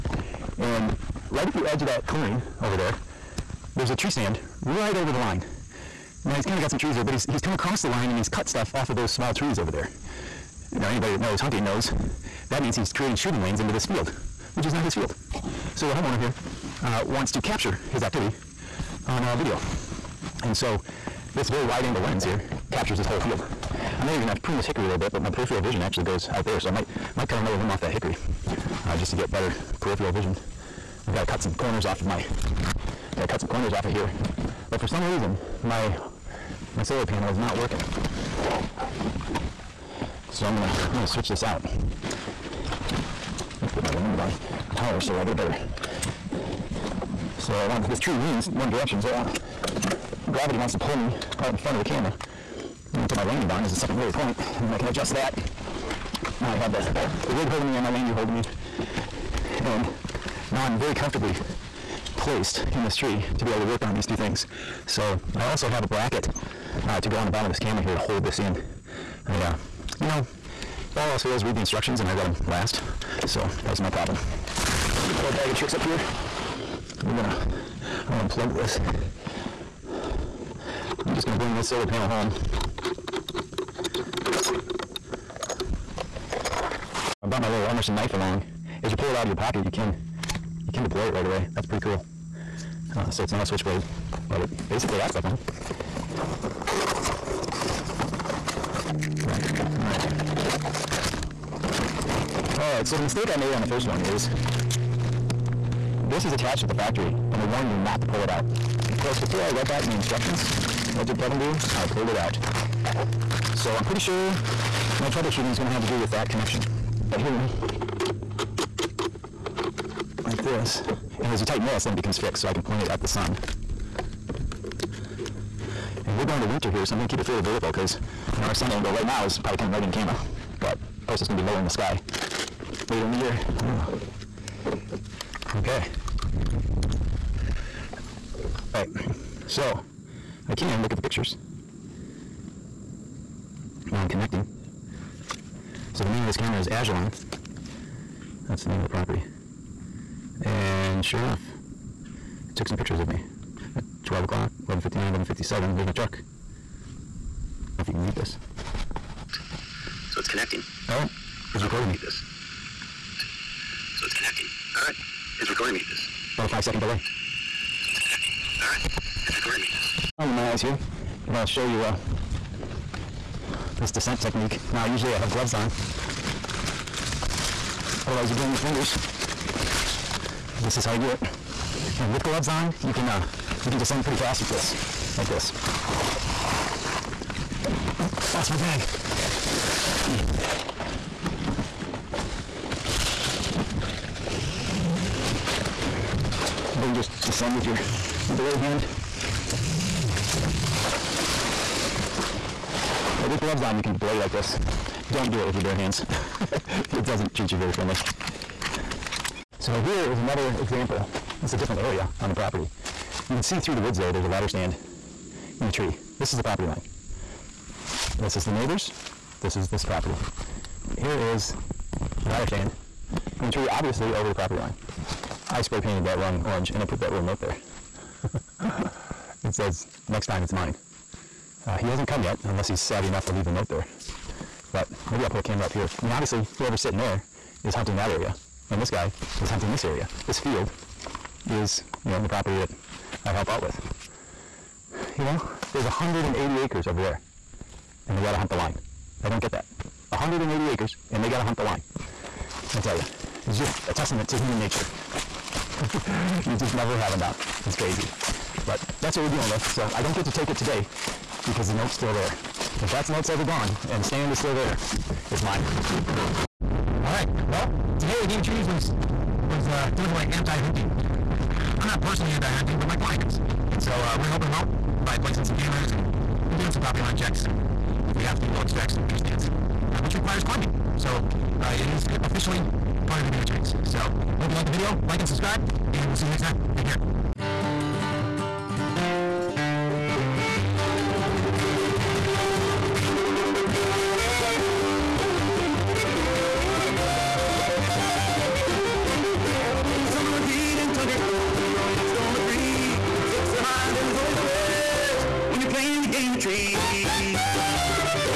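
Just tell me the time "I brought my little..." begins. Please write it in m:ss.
1:27.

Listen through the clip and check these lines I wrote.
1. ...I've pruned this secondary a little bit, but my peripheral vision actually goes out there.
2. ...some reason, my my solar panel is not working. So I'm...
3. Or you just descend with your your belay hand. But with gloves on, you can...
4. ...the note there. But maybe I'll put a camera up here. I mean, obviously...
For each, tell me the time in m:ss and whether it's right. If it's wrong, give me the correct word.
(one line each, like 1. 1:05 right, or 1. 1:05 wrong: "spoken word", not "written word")
1. 0:24 wrong: "hickory", not "secondary"
2. 0:34 right
3. 3:16 right
4. 3:53 right.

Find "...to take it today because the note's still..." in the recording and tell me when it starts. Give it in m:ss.
4:20.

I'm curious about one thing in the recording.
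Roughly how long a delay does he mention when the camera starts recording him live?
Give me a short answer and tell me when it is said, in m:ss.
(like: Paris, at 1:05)
5 seconds, at 2:46.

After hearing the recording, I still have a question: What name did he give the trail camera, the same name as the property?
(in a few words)
Agilon.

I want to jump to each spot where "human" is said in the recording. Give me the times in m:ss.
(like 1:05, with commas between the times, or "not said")
4:14.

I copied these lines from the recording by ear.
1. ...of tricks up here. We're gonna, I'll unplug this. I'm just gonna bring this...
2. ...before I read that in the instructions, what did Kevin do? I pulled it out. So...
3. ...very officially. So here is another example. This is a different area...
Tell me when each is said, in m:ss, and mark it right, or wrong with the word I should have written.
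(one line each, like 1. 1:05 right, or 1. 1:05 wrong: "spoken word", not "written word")
1. 1:15 right
2. 1:49 right
3. 3:27 wrong: "friendly", not "officially".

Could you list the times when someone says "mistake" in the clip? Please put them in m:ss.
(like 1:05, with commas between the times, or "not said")
1:43.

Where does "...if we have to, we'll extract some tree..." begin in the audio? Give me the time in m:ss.
4:38.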